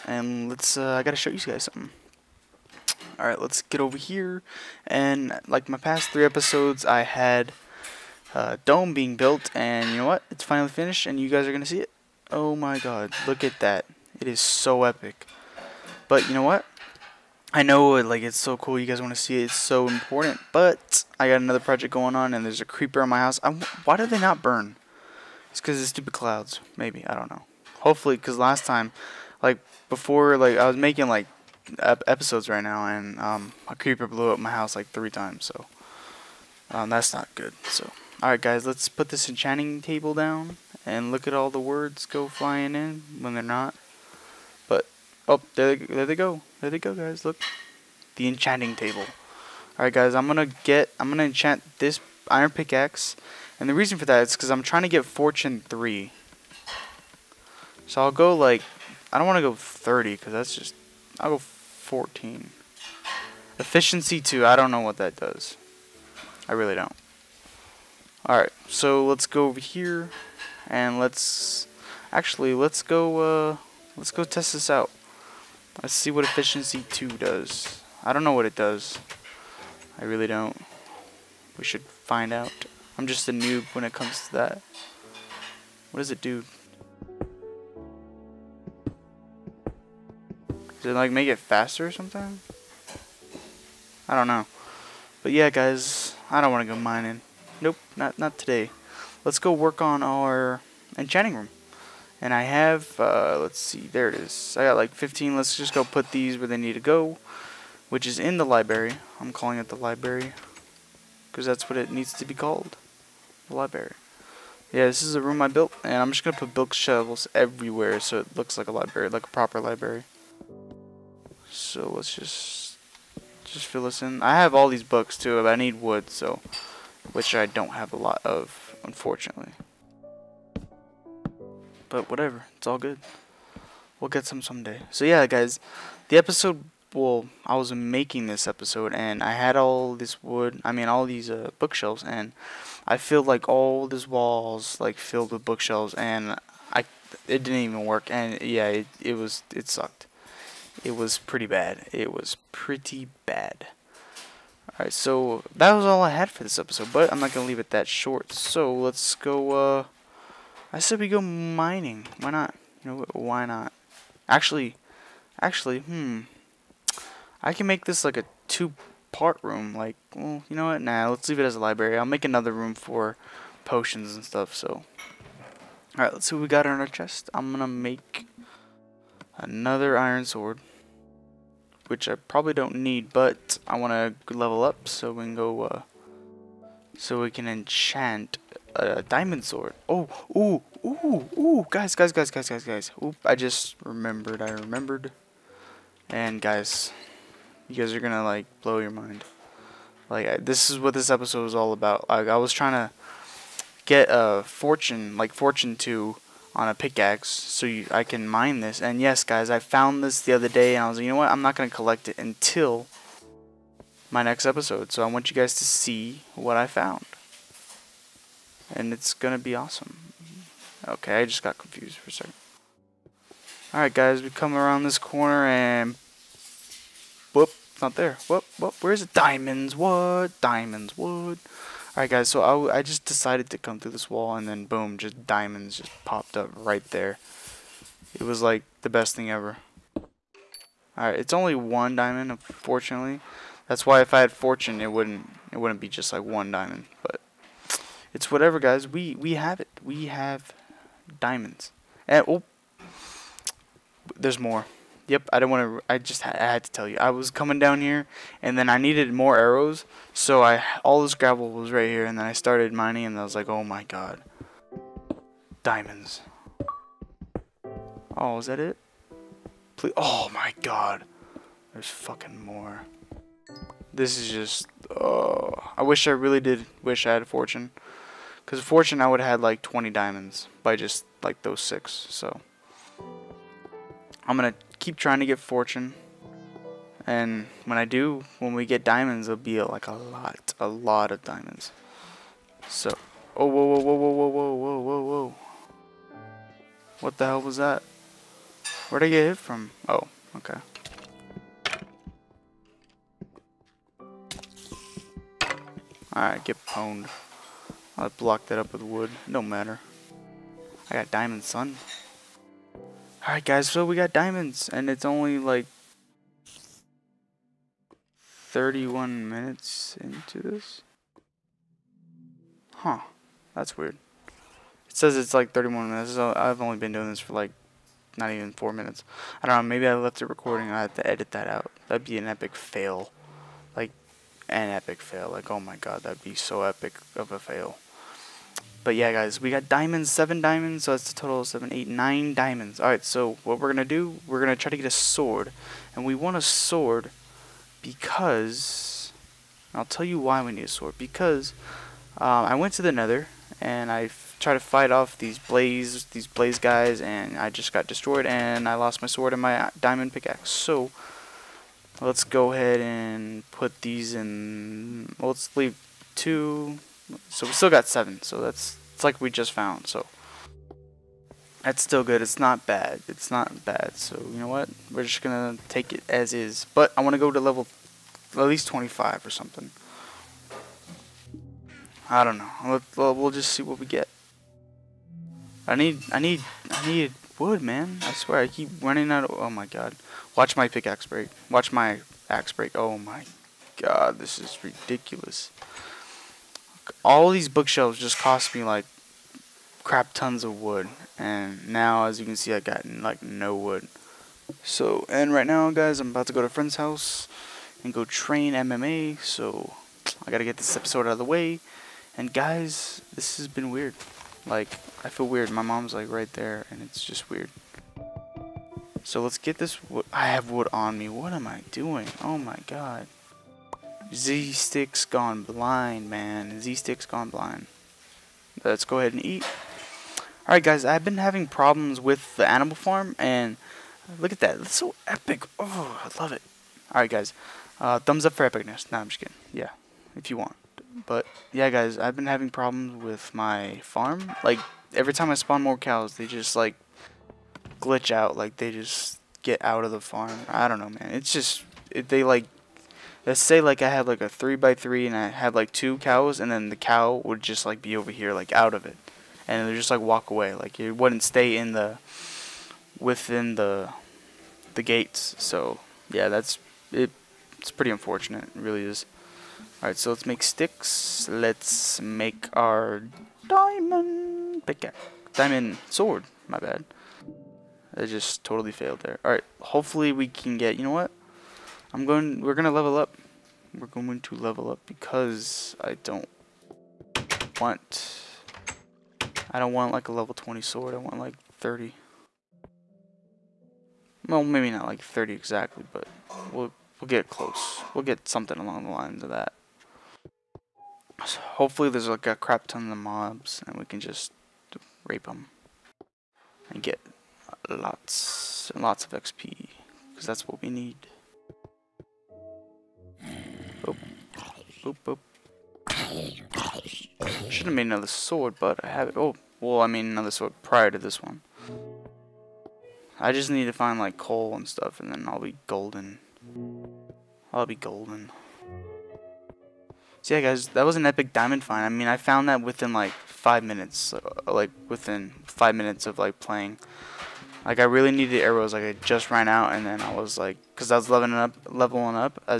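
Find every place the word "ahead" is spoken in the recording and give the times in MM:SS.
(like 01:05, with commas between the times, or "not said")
06:02, 07:08.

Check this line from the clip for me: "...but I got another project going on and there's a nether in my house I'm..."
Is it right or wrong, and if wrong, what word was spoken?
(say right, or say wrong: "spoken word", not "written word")
wrong: "creeper", not "nether".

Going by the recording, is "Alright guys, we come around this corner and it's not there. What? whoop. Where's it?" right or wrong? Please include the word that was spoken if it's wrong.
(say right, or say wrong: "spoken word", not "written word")
right.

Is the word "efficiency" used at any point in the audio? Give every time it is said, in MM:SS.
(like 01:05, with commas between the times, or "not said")
01:03, 01:16.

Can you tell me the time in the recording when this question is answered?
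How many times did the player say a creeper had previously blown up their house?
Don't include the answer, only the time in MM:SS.
00:34.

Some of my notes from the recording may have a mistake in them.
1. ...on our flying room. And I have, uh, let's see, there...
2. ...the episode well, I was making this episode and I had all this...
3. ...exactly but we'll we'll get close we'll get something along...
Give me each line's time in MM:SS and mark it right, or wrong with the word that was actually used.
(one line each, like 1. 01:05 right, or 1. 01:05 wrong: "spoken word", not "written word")
1. 01:39 wrong: "enchanting", not "flying"
2. 02:16 right
3. 08:15 right.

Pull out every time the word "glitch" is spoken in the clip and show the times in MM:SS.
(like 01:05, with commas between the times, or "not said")
07:27.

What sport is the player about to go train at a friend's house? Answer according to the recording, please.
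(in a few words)
MMA.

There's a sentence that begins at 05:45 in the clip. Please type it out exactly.
And we want a sword because...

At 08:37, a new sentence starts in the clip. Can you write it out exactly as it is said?
Should have been another sword, but I have it.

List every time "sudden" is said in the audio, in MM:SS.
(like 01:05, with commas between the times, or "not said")
not said.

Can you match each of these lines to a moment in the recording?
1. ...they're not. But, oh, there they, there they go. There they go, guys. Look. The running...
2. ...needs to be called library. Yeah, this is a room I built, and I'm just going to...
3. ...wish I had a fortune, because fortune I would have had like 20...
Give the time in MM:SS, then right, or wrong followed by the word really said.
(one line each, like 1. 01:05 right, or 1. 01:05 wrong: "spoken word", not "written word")
1. 00:43 wrong: "enchanting", not "running"
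2. 01:51 right
3. 04:36 right.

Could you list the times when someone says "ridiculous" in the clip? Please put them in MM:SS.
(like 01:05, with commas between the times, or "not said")
06:34.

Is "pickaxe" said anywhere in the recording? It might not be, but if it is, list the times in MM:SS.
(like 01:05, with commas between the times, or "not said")
00:52, 03:26, 06:00, 06:30, 07:54.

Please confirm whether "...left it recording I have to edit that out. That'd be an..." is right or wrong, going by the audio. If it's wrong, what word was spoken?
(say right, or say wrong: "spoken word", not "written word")
right.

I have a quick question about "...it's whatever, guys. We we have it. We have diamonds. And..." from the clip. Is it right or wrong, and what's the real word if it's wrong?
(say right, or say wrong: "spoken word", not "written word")
right.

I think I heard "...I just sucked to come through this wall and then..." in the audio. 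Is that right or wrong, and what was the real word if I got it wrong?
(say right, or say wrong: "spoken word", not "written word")
wrong: "decided", not "sucked".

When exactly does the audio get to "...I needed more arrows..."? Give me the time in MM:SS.
04:18.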